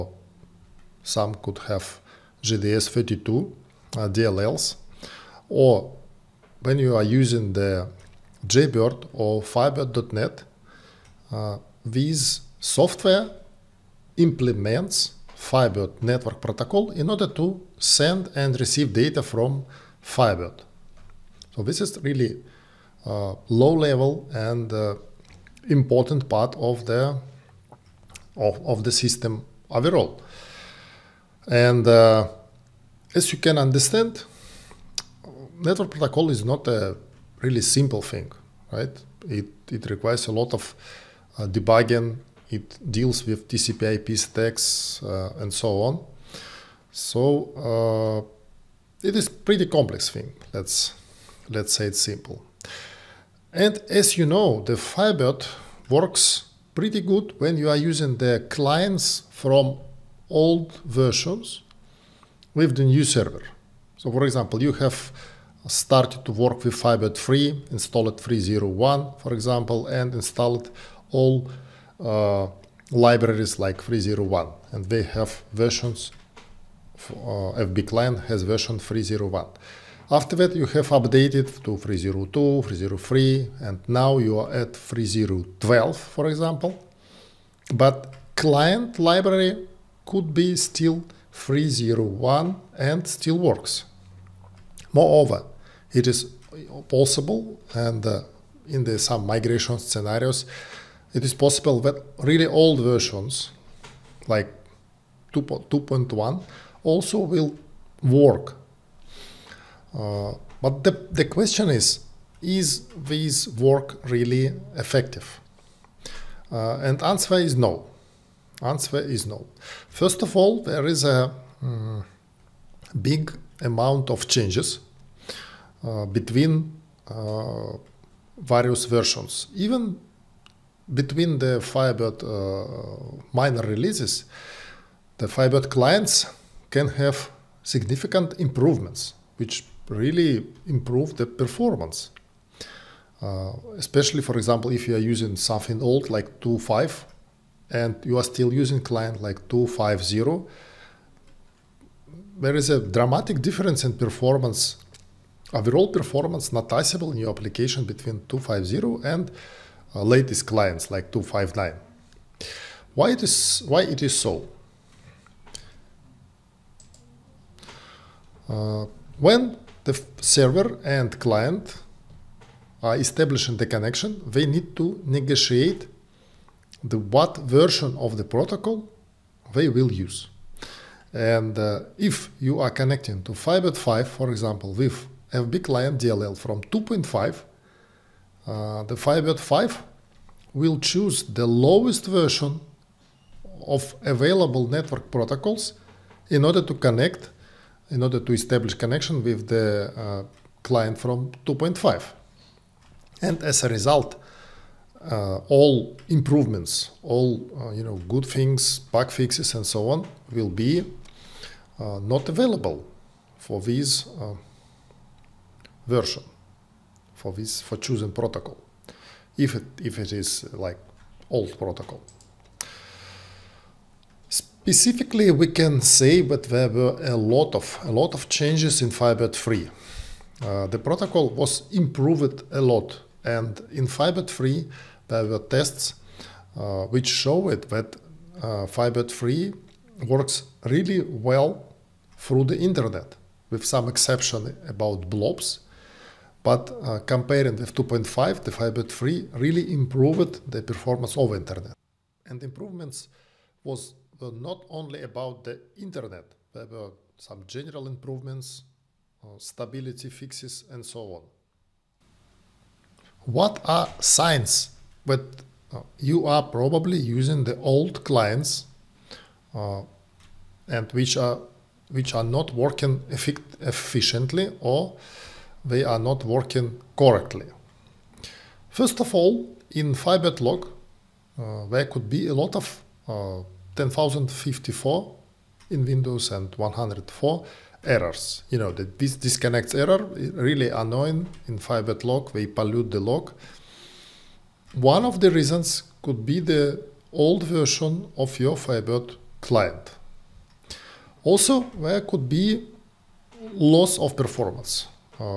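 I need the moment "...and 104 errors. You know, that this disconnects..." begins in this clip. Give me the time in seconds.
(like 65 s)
286 s.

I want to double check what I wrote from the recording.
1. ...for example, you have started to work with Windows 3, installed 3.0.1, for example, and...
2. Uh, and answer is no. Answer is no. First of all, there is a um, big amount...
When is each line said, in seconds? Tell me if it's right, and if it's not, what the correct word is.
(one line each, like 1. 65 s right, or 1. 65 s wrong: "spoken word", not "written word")
1. 64 s wrong: "Firebird", not "Windows"
2. 116 s right.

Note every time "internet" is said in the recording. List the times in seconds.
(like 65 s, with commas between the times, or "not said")
242 s, 251 s, 255 s.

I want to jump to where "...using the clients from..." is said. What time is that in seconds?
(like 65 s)
57 s.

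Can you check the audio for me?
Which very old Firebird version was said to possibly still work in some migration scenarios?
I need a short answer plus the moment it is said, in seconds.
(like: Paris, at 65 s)
2.1, at 105 s.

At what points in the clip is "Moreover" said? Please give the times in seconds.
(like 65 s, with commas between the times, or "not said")
94 s.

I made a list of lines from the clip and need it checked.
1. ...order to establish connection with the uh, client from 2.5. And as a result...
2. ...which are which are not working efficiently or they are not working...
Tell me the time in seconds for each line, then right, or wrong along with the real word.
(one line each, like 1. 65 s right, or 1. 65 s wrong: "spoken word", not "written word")
1. 198 s right
2. 270 s right.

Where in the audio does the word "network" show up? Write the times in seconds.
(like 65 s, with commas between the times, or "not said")
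16 s, 35 s, 194 s.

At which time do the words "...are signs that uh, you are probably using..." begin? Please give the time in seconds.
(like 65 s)
263 s.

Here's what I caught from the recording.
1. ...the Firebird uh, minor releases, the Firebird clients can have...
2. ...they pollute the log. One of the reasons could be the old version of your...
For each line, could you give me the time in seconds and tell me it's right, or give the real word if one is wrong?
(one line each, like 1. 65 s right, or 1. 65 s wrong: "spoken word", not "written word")
1. 131 s right
2. 292 s right.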